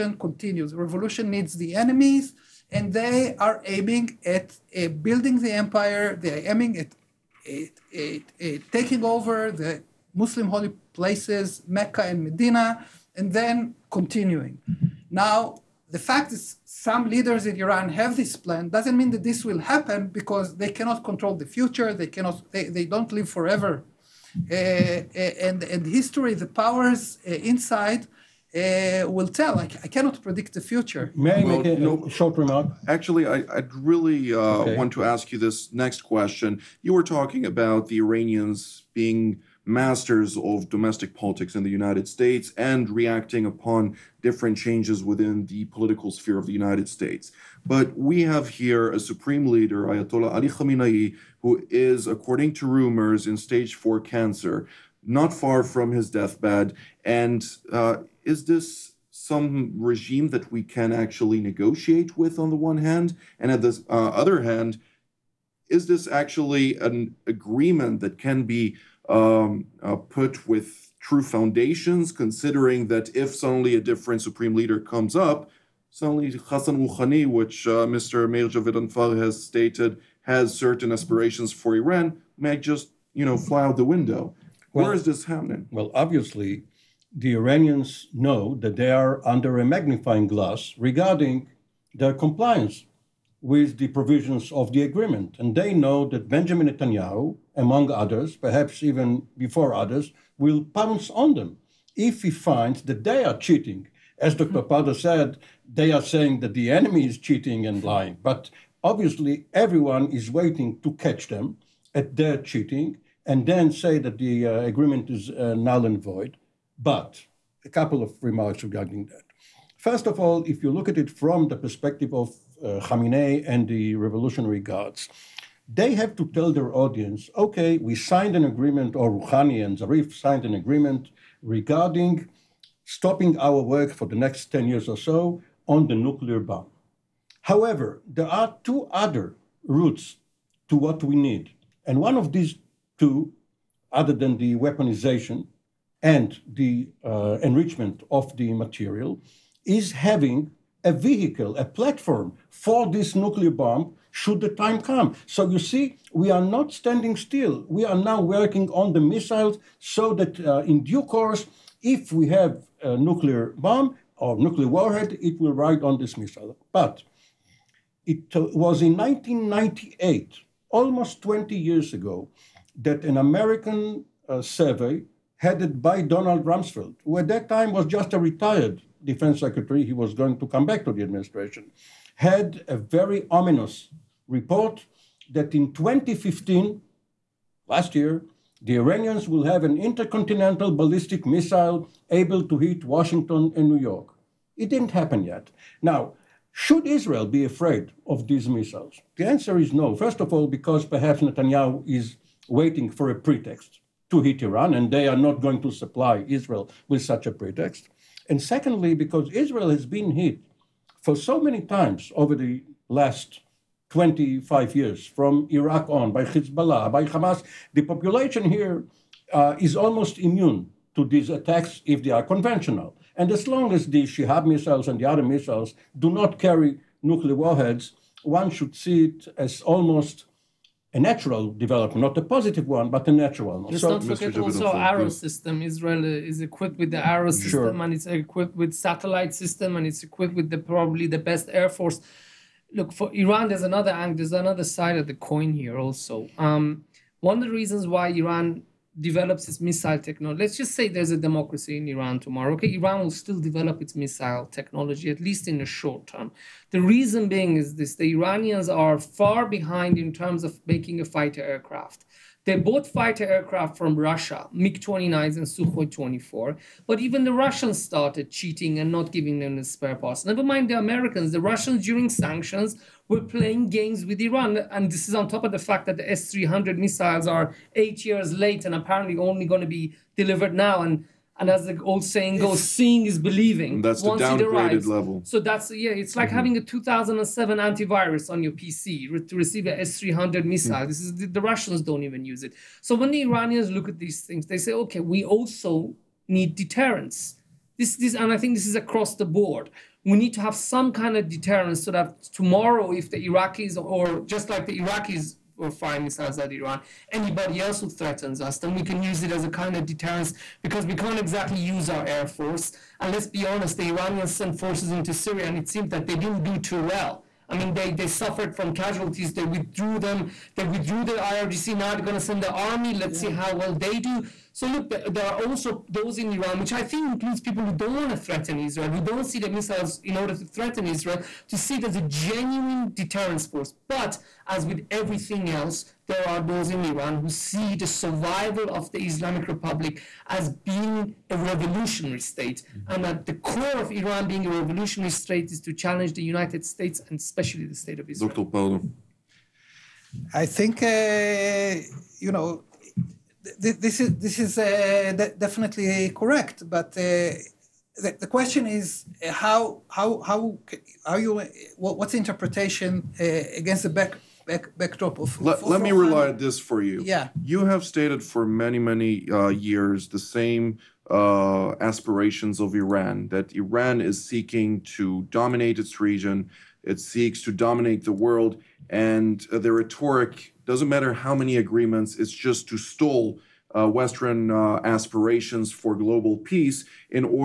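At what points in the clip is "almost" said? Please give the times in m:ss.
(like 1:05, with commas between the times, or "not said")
2:50, 3:39, 3:49.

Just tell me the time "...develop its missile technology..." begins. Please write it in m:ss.
4:13.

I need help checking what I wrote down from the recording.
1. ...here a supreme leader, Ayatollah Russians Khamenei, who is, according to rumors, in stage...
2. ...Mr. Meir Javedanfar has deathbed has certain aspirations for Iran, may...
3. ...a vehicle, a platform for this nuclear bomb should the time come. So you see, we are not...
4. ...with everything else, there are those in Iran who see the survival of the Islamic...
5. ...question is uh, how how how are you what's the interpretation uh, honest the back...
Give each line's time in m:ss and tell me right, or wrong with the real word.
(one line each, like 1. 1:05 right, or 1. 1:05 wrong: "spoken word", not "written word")
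1. 0:48 wrong: "Ali", not "Russians"
2. 1:17 wrong: "stated", not "deathbed"
3. 2:30 right
4. 5:34 right
5. 5:58 wrong: "against", not "honest".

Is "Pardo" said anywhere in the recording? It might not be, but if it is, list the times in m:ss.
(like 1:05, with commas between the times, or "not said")
1:44, 5:48.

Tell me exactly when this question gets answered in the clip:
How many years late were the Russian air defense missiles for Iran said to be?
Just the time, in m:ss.
4:37.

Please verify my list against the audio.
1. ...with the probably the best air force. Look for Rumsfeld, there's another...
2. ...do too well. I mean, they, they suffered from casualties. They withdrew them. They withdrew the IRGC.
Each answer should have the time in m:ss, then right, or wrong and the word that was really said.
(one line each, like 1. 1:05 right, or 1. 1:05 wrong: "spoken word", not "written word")
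1. 4:00 wrong: "Iran", not "Rumsfeld"
2. 5:16 right.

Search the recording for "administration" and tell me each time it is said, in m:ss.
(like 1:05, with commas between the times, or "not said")
3:01.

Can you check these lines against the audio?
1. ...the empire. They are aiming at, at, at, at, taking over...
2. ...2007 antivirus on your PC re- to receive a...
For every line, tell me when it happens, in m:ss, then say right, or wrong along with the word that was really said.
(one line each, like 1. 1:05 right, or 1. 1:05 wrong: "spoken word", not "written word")
1. 0:05 right
2. 4:46 right.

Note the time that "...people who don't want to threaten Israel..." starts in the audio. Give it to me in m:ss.
5:27.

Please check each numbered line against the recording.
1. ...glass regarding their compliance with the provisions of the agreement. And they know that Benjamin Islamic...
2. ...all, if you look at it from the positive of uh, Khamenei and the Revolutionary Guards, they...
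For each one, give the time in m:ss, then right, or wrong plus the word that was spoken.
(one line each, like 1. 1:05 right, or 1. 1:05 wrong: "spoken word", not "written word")
1. 1:30 wrong: "Netanyahu", not "Islamic"
2. 2:00 wrong: "perspective", not "positive".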